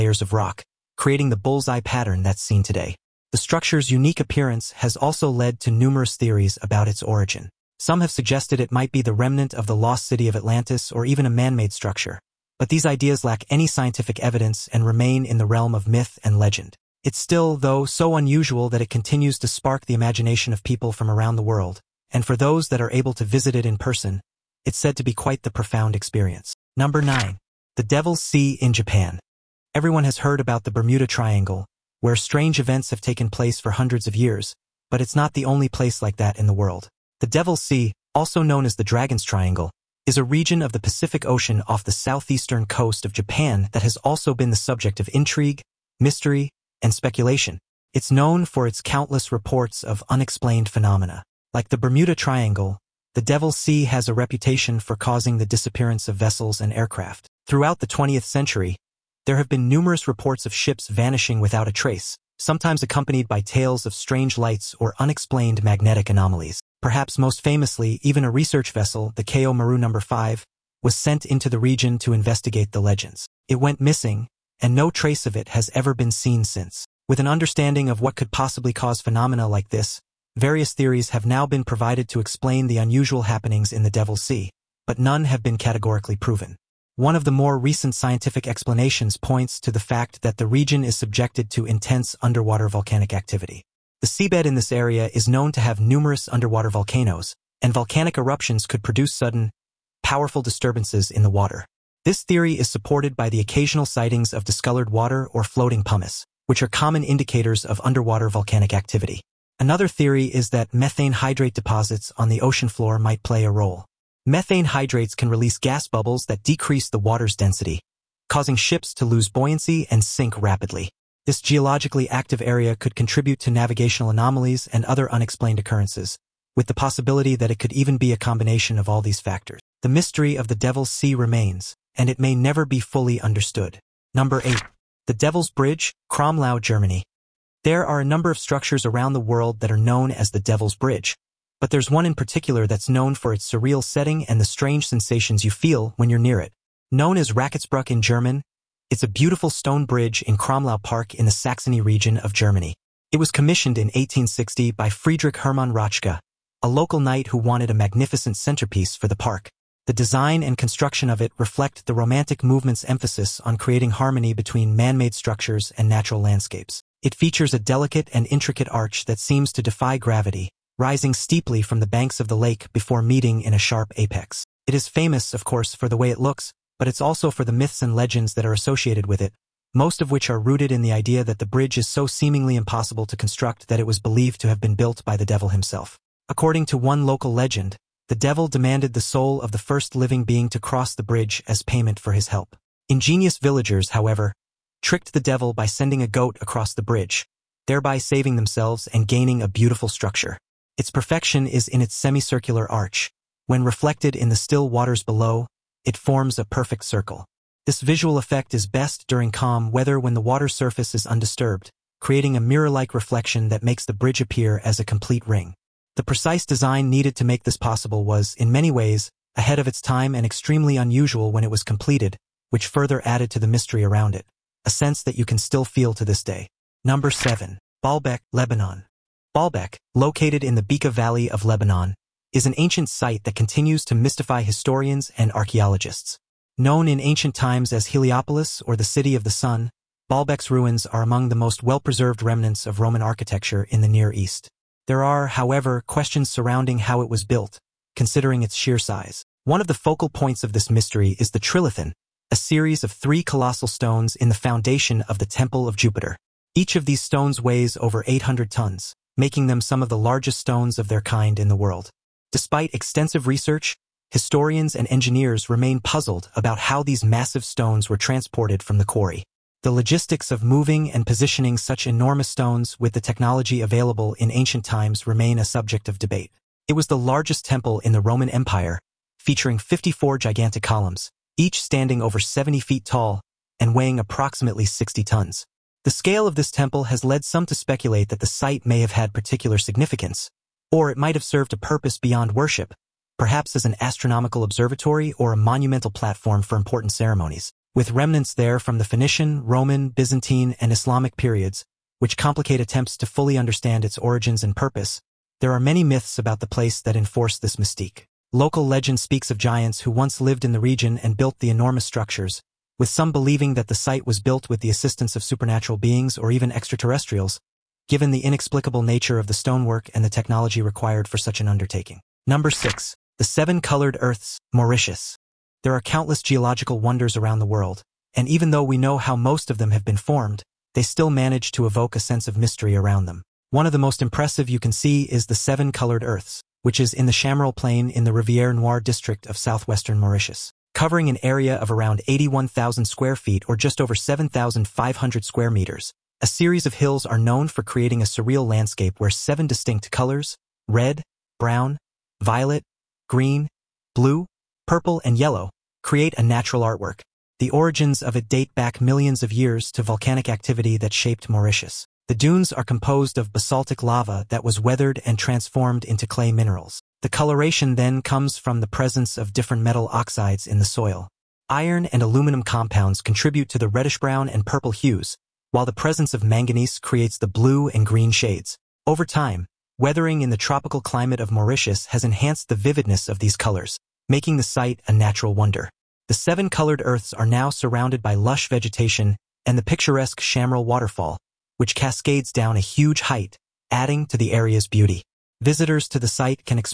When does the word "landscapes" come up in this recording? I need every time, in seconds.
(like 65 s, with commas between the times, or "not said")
166 s, 348 s.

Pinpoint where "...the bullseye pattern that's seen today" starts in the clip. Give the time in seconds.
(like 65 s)
1 s.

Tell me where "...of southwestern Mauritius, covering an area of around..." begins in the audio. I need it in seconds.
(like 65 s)
339 s.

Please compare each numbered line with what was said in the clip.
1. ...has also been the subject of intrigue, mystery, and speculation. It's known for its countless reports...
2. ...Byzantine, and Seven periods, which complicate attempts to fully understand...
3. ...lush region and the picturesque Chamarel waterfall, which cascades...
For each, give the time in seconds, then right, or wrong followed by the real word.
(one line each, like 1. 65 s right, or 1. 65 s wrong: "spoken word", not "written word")
1. 43 s right
2. 299 s wrong: "Islamic", not "Seven"
3. 388 s wrong: "vegetation", not "region".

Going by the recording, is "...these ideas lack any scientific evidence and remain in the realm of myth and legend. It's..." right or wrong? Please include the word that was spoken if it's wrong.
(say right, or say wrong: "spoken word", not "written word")
right.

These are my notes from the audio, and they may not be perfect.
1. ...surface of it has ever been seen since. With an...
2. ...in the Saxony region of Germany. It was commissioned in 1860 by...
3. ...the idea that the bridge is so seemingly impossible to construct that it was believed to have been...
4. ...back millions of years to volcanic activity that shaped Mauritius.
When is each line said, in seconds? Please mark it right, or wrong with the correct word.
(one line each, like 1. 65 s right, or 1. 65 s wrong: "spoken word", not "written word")
1. 74 s wrong: "trace", not "surface"
2. 151 s right
3. 180 s right
4. 358 s right.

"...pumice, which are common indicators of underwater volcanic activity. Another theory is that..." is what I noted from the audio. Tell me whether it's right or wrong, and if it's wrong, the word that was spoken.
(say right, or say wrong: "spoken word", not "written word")
right.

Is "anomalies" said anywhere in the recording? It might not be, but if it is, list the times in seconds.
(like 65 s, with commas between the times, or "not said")
66 s, 124 s.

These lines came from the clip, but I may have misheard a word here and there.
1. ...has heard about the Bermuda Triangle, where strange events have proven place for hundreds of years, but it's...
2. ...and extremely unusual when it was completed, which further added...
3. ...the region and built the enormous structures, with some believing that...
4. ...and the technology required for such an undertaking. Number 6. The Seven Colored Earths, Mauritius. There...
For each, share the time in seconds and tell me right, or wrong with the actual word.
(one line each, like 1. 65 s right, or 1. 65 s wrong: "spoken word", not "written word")
1. 30 s wrong: "taken", not "proven"
2. 220 s right
3. 310 s right
4. 319 s right.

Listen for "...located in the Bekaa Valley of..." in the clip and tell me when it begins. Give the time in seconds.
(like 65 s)
229 s.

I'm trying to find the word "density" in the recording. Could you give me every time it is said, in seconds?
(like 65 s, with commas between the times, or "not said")
117 s.